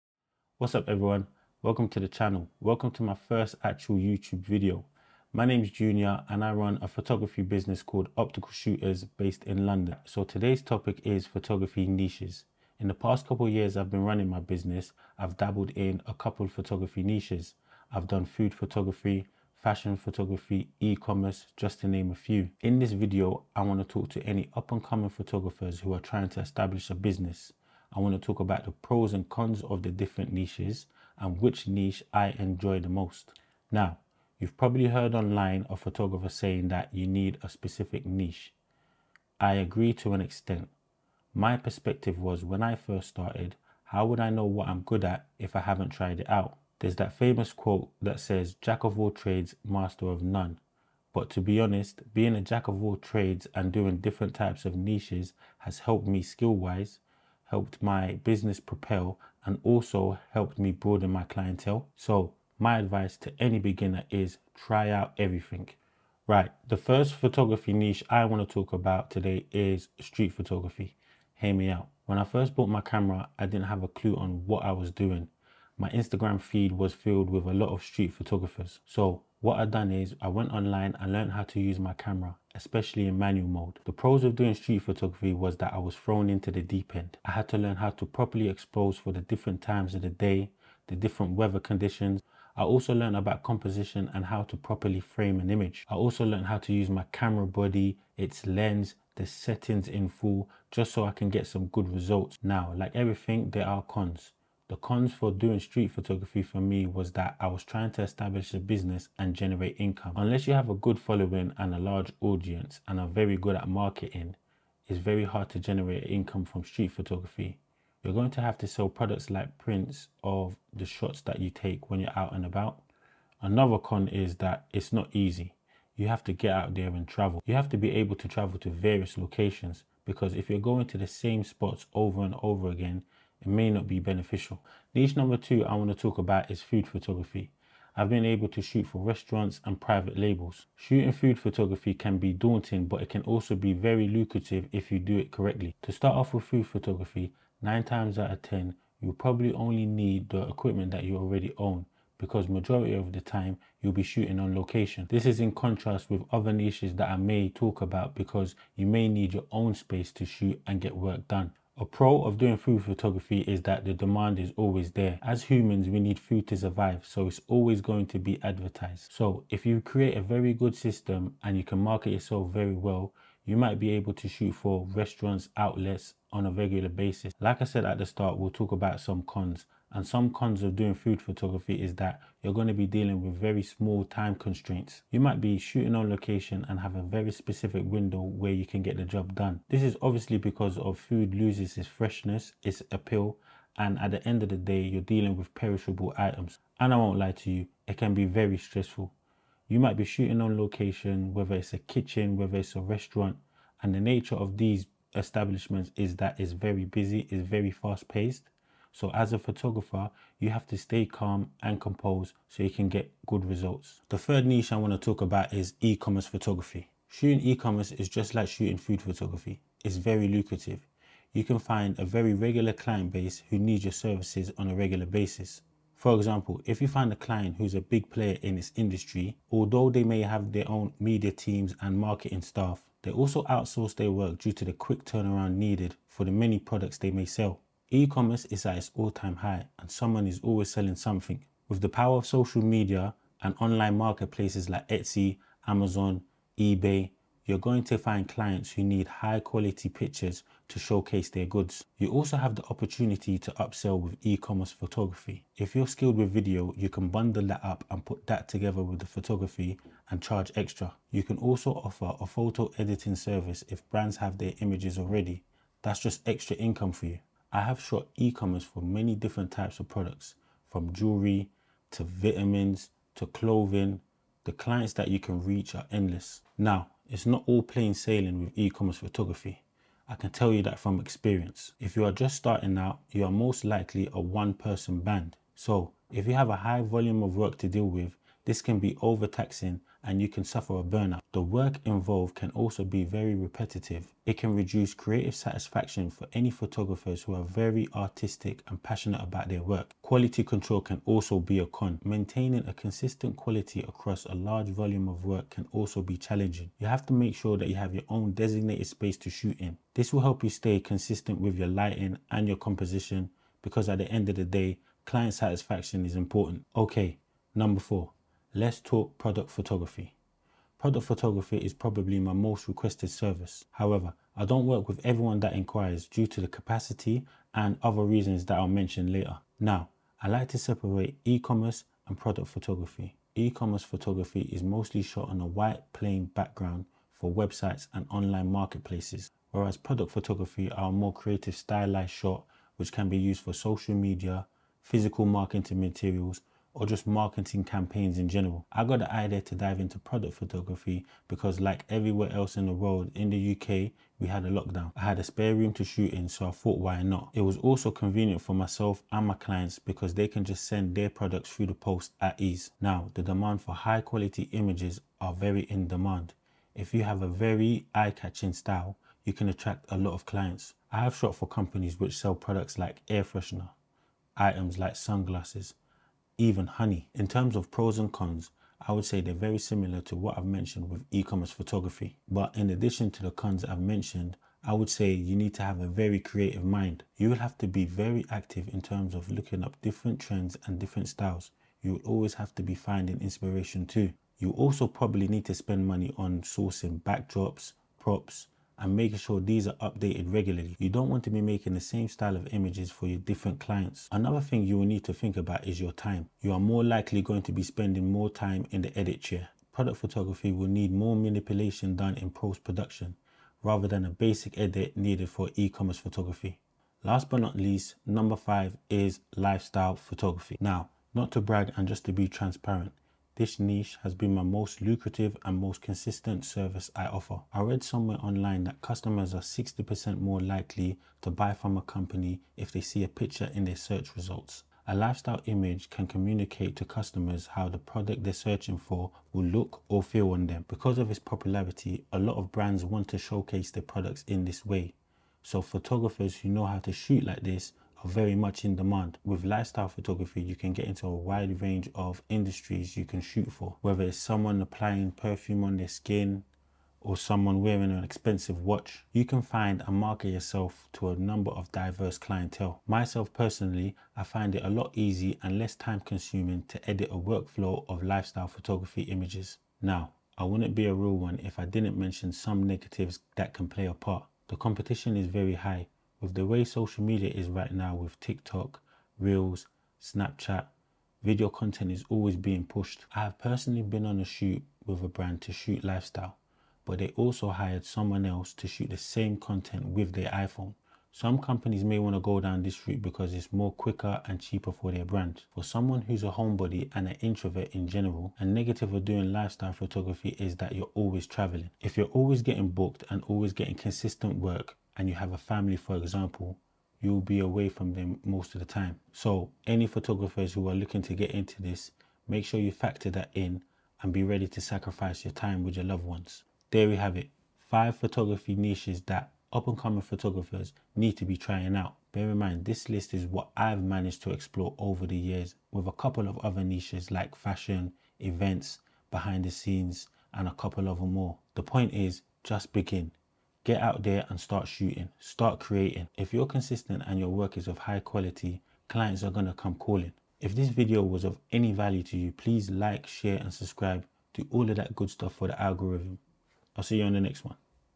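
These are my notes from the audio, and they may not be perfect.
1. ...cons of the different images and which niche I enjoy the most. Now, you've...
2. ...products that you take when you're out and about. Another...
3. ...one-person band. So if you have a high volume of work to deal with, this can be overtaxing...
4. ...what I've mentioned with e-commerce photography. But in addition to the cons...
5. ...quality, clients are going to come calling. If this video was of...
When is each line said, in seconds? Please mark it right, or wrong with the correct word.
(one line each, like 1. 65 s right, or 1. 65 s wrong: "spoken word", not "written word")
1. 29 s wrong: "niches", not "images"
2. 120 s wrong: "shots", not "products"
3. 284 s right
4. 380 s right
5. 537 s right.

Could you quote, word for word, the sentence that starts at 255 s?
If you're skilled with video, you can bundle that up and put that together with the photography and charge extra.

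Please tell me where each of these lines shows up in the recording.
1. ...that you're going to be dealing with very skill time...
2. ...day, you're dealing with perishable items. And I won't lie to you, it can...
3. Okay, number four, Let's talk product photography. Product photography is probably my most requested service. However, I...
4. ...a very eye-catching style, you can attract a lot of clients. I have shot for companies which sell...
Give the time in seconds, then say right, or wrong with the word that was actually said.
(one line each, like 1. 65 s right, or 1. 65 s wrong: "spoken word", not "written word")
1. 181 s wrong: "small", not "skill"
2. 194 s right
3. 316 s right
4. 367 s right.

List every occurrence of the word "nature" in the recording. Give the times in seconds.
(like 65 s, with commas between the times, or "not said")
204 s.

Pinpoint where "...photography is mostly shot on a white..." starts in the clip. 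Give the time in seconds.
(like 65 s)
333 s.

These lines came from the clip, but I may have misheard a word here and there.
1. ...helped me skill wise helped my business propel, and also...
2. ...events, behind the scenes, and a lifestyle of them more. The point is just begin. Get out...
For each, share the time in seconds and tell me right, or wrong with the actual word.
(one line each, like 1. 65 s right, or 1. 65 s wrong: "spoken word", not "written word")
1. 55 s right
2. 528 s wrong: "couple", not "lifestyle".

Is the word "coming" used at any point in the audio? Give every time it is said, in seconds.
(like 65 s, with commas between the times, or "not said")
24 s, 519 s.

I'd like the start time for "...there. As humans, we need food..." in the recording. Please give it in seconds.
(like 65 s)
164 s.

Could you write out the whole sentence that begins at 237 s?
E-commerce is at its all-time high and someone is always selling something.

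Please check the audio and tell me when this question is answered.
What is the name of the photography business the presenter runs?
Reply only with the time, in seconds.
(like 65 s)
8 s.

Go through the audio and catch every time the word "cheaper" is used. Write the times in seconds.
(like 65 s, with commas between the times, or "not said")
494 s.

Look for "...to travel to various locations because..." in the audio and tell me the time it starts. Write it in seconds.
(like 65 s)
128 s.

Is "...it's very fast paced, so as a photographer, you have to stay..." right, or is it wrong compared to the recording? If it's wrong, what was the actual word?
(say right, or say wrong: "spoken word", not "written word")
right.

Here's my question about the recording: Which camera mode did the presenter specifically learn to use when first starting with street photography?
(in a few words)
Manual mode.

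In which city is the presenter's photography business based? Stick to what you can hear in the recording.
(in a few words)
London.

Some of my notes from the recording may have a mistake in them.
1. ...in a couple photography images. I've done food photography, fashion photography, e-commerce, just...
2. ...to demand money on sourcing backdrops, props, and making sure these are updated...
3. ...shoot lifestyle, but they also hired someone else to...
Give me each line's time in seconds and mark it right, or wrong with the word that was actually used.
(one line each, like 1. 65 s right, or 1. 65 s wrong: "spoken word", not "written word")
1. 15 s wrong: "niches", not "images"
2. 395 s wrong: "spend", not "demand"
3. 485 s right.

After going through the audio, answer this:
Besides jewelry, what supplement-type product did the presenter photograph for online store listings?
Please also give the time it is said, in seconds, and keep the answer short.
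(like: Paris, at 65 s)
Vitamins, at 272 s.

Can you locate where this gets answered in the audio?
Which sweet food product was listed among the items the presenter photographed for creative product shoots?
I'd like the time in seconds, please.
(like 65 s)
376 s.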